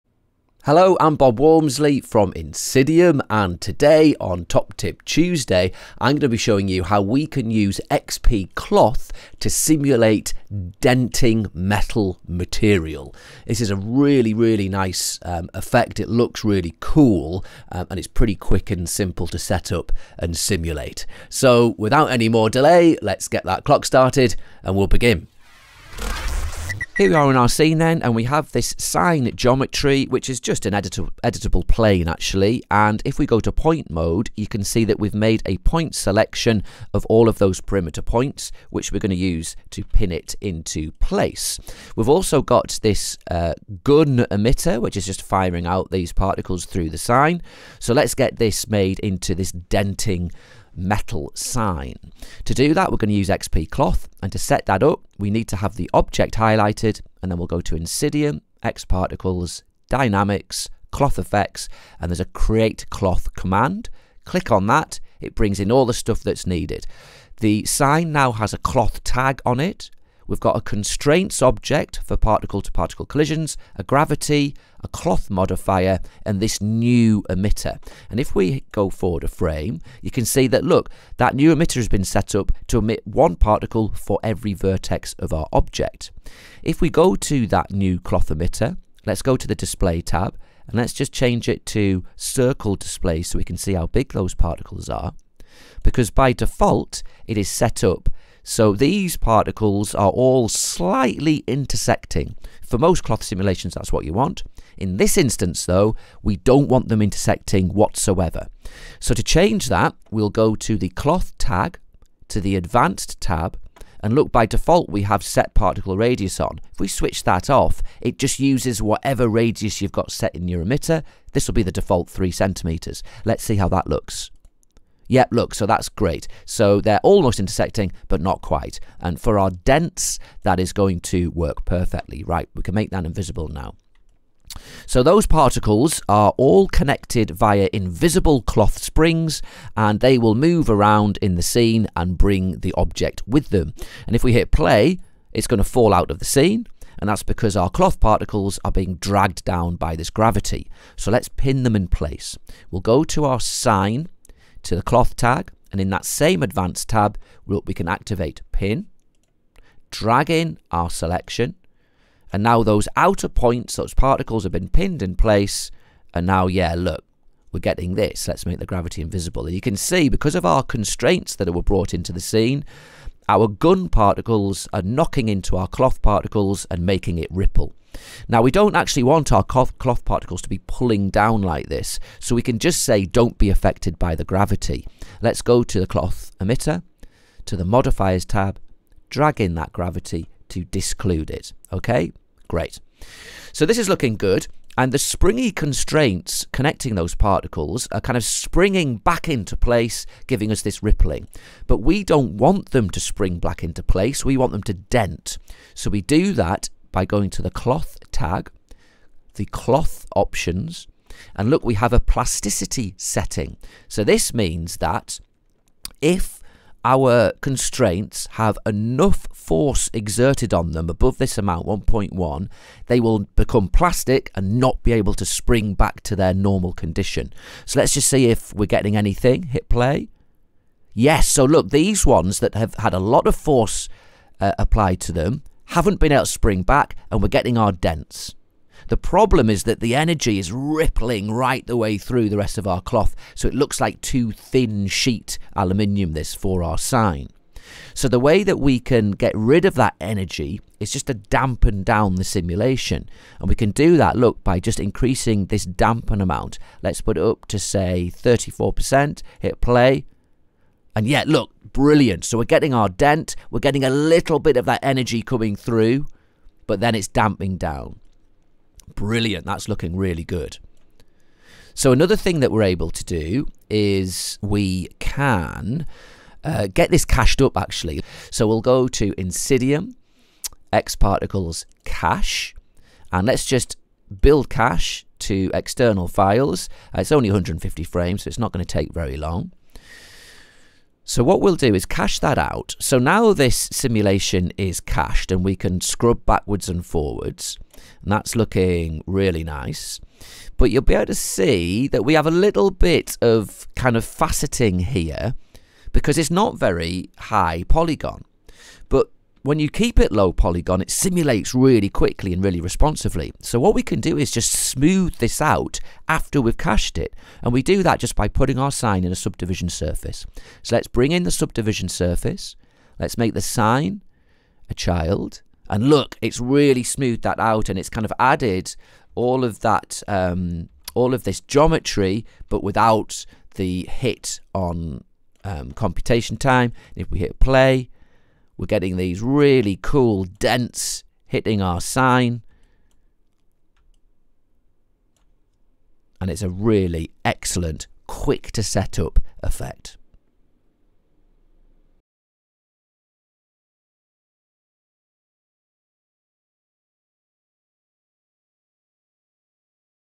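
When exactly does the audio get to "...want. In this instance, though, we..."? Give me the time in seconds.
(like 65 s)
104 s.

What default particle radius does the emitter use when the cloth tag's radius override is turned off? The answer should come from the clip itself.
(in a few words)
3 centimeters.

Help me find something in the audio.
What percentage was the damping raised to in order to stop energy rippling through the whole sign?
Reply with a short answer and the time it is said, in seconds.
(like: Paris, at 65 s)
34%, at 258 s.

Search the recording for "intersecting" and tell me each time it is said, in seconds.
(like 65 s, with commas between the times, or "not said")
101 s, 107 s, 127 s.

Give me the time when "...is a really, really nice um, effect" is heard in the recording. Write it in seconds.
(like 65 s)
13 s.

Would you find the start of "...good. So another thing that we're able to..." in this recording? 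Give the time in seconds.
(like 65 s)
270 s.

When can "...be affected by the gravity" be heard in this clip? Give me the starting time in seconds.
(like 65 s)
183 s.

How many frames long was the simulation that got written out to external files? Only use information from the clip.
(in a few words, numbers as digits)
150.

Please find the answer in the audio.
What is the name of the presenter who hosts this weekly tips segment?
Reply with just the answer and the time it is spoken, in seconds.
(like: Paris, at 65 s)
Bob Walmsley, at 1 s.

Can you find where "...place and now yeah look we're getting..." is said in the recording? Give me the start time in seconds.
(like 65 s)
165 s.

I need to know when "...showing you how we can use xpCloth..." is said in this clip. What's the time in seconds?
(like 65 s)
6 s.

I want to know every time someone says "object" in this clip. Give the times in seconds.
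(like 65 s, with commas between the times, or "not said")
55 s, 71 s, 85 s, 142 s.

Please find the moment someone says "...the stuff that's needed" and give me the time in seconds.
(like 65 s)
65 s.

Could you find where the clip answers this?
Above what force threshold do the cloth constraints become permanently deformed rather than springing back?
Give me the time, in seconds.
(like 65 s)
221 s.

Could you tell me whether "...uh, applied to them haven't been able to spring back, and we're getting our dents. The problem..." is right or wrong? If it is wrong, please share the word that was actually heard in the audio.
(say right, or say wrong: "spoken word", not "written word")
right.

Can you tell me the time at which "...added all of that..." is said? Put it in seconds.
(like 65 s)
328 s.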